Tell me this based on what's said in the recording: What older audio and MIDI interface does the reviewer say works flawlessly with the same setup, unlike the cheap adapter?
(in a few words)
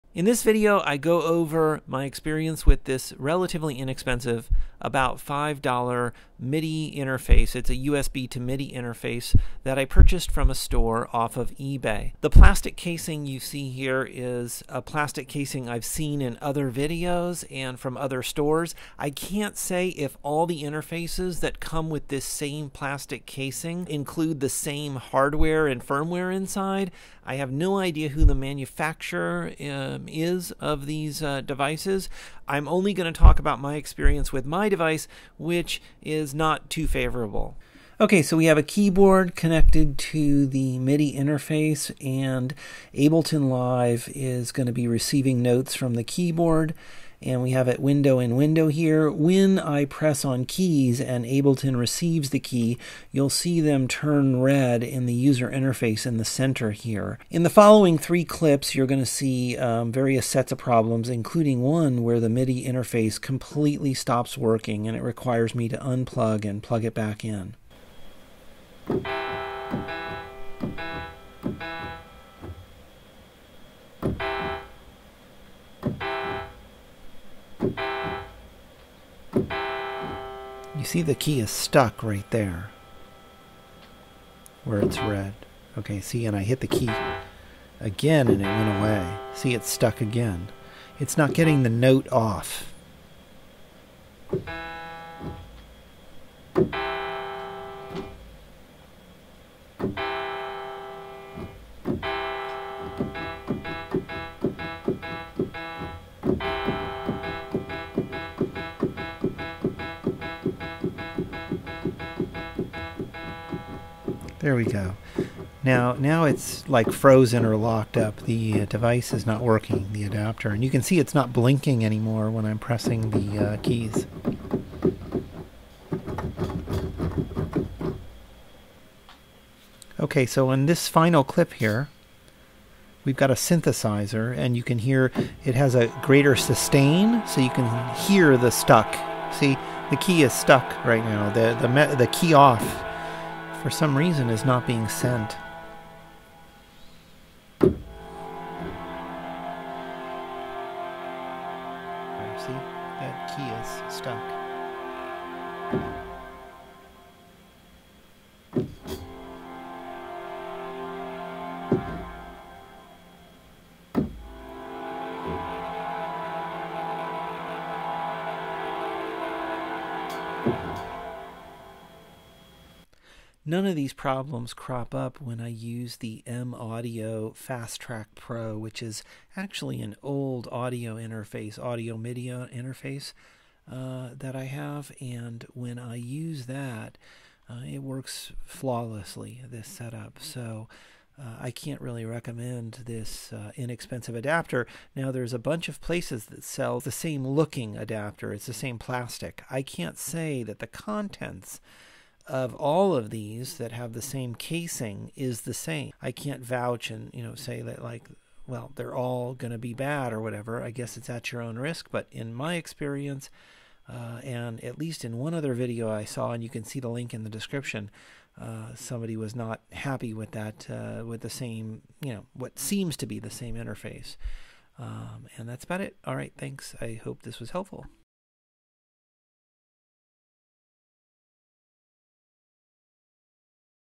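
M Audio Fast Track Pro.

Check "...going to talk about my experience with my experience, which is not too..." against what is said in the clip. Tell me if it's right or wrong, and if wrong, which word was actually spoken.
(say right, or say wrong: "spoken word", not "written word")
wrong: "device", not "experience".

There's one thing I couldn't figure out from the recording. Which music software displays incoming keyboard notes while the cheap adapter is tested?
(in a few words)
Ableton Live.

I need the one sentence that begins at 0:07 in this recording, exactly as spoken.
It's a USB to MIDI interface that I purchased from a store off of eBay.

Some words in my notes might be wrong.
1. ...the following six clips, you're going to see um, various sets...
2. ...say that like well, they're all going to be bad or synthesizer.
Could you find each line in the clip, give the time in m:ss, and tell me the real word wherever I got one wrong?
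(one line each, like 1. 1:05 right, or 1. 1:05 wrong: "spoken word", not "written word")
1. 0:57 wrong: "three", not "six"
2. 3:27 wrong: "whatever", not "synthesizer".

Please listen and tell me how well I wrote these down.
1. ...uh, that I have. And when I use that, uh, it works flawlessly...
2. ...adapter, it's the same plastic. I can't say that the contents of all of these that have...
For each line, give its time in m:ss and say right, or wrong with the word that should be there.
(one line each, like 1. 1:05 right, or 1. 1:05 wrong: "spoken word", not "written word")
1. 3:03 right
2. 3:17 right.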